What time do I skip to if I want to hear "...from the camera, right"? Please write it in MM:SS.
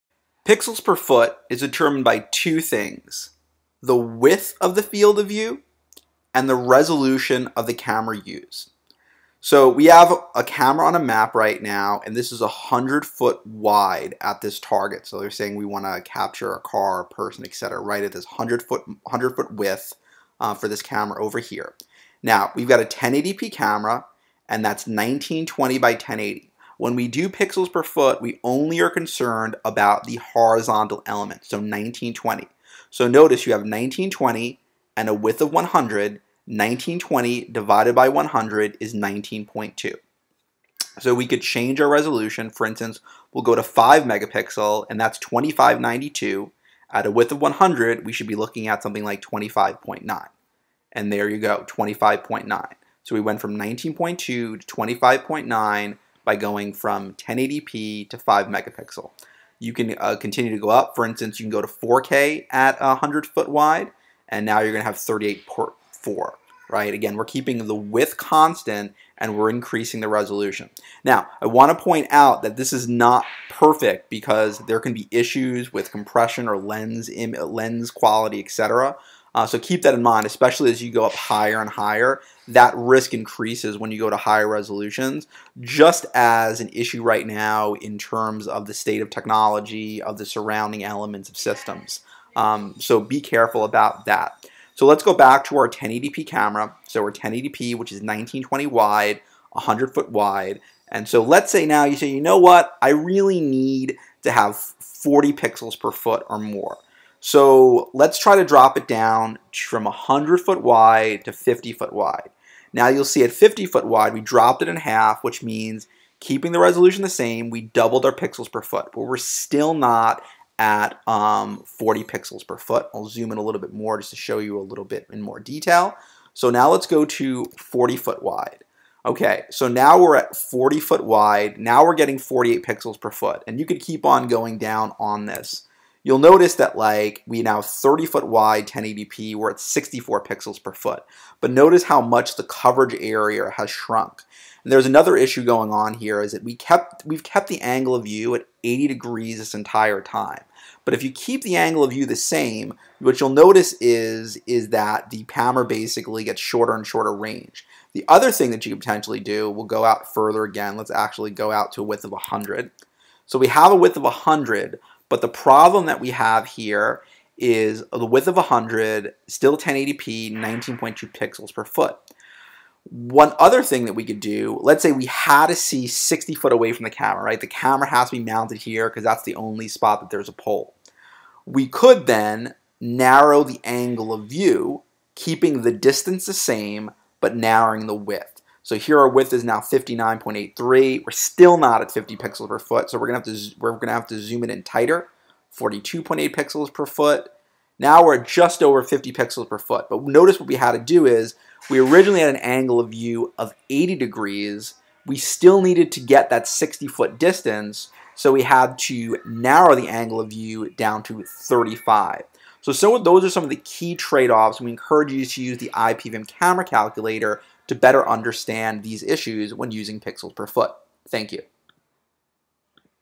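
02:56.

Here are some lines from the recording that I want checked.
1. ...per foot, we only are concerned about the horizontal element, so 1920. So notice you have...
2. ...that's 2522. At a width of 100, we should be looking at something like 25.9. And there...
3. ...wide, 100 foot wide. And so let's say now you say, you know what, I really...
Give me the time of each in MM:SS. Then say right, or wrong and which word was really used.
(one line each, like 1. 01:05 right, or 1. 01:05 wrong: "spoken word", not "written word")
1. 00:27 right
2. 00:44 wrong: "2592", not "2522"
3. 01:38 right.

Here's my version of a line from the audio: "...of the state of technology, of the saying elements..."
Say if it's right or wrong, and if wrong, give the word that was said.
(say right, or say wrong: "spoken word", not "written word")
wrong: "surrounding", not "saying".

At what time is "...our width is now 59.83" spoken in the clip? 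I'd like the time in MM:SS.
03:08.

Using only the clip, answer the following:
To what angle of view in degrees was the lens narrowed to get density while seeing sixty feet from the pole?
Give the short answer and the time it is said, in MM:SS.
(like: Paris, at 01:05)
35, at 03:31.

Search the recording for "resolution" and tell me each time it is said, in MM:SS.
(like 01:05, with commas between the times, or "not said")
00:06, 00:41, 01:10, 01:24, 01:56.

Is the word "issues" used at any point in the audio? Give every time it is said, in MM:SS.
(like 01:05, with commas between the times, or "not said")
01:15, 01:26, 02:25, 03:39.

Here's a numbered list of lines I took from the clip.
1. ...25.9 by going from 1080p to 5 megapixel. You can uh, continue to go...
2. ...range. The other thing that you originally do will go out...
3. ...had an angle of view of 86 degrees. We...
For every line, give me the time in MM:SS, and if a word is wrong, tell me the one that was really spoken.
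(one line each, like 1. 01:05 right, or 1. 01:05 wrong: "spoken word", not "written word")
1. 00:54 right
2. 02:37 wrong: "potentially", not "originally"
3. 03:22 wrong: "80", not "86".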